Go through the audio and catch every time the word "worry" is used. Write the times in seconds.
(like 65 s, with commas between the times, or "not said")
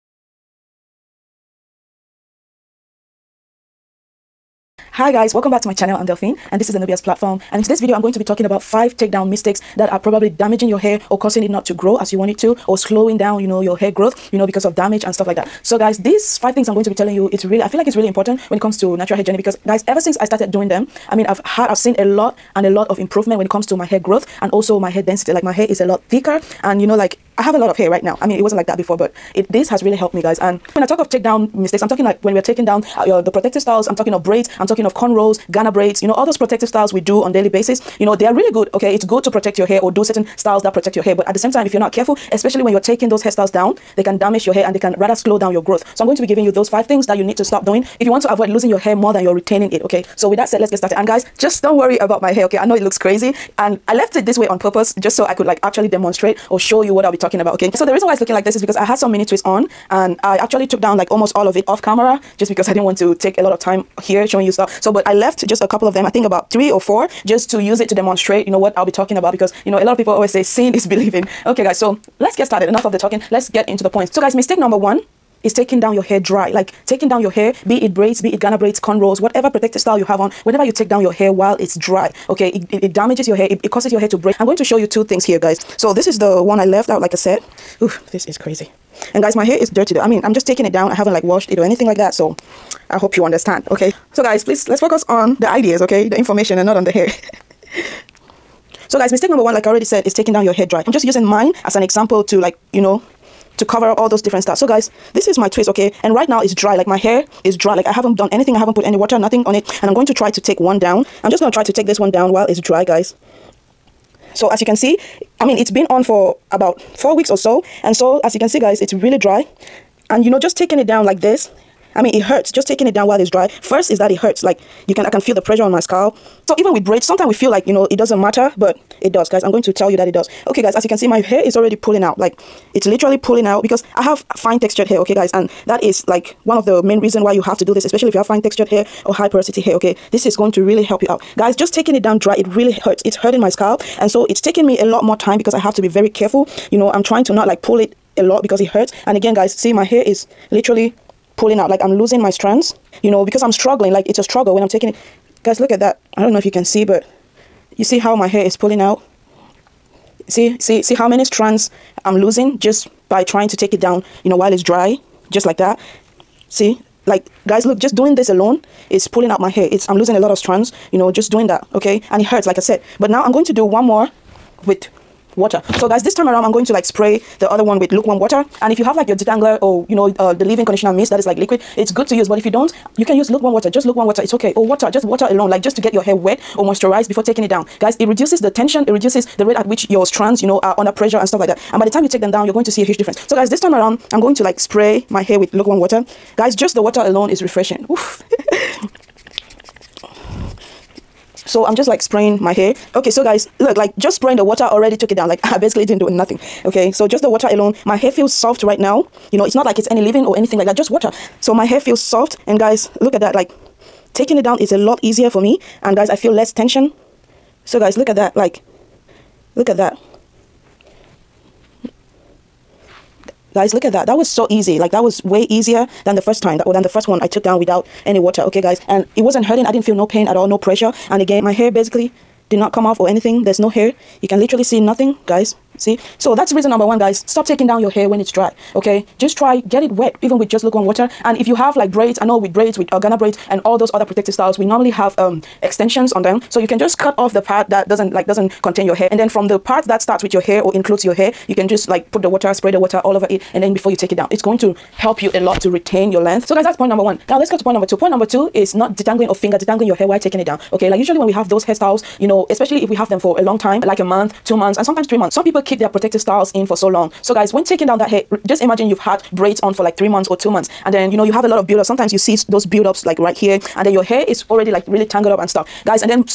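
51 s.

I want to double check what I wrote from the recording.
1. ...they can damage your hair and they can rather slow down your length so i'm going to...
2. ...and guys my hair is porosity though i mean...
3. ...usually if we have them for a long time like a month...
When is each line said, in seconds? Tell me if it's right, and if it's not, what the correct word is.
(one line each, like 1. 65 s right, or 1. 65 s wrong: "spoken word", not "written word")
1. 43 s wrong: "growth", not "length"
2. 89 s wrong: "dirty", not "porosity"
3. 262 s wrong: "especially", not "usually".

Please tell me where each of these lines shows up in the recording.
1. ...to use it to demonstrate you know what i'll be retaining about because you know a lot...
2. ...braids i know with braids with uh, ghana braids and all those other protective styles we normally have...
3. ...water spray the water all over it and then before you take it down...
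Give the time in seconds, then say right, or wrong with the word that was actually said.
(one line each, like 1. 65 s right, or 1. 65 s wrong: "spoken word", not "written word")
1. 67 s wrong: "talking", not "retaining"
2. 241 s right
3. 252 s right.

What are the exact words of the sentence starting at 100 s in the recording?
I'm just using mine as an example to like, you know, to cover up all those different styles.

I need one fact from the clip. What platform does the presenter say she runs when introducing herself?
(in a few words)
Nubia's platform.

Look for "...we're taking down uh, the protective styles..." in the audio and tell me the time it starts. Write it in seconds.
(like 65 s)
32 s.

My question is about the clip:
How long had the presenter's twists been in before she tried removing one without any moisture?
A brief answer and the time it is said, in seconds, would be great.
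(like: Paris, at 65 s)
about four weeks, at 116 s.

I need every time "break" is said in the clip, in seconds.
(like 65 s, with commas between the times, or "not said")
84 s.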